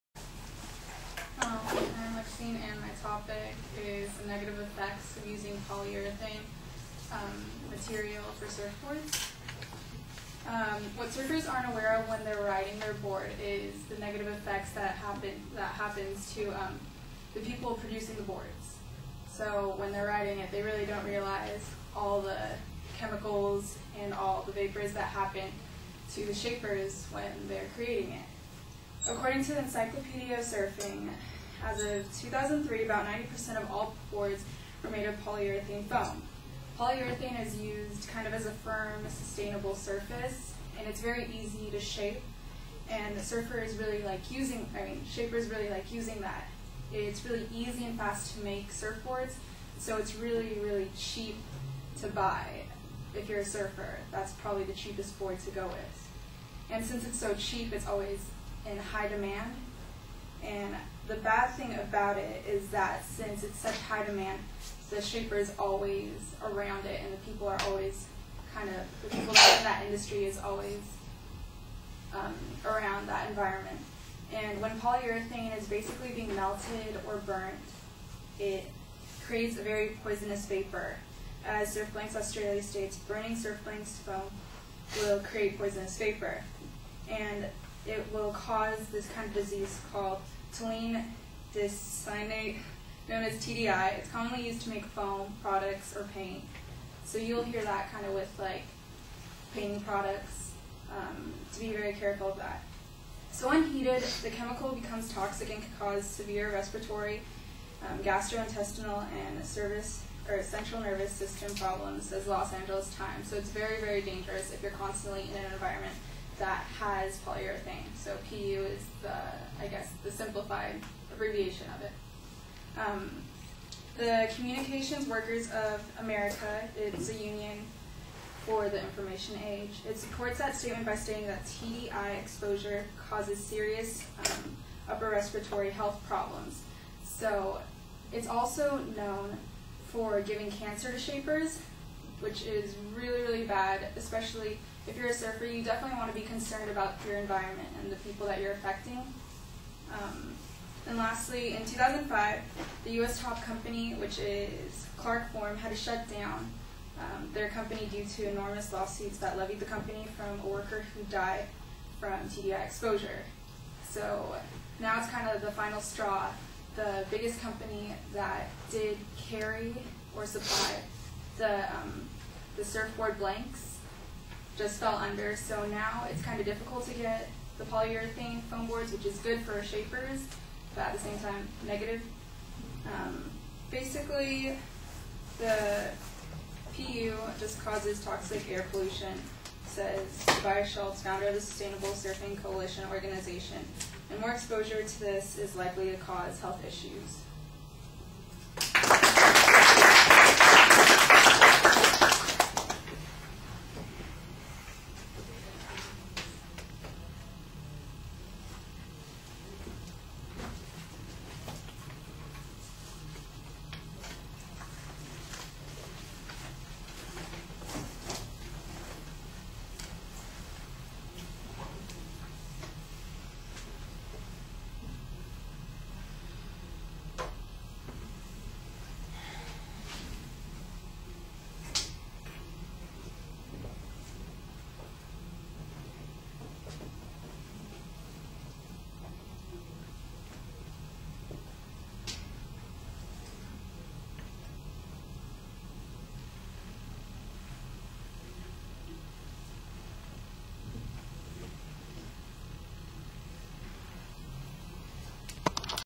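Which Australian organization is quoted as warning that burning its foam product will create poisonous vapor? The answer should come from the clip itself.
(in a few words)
Surfblanks Australia.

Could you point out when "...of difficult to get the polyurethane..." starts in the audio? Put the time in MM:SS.
02:56.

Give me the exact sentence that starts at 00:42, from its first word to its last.
And the surfer is really like using, I mean, shapers really like using that.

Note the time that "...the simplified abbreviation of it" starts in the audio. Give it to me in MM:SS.
02:00.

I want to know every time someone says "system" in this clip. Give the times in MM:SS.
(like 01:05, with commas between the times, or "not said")
01:51.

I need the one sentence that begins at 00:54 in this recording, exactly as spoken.
That's probably the cheapest board to go with.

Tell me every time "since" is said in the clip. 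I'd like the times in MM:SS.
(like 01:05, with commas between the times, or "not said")
00:56, 01:03.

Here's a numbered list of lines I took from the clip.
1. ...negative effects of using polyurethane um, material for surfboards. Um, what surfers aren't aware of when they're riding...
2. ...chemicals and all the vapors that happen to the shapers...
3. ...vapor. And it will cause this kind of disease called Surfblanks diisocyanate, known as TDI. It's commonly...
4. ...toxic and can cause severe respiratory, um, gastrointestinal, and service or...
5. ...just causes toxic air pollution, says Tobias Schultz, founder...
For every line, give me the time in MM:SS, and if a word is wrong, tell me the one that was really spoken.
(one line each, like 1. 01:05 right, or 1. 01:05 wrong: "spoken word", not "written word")
1. 00:04 right
2. 00:22 right
3. 01:25 wrong: "Toluene", not "Surfblanks"
4. 01:45 right
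5. 03:07 right.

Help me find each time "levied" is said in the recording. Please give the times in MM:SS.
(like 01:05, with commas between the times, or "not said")
02:39.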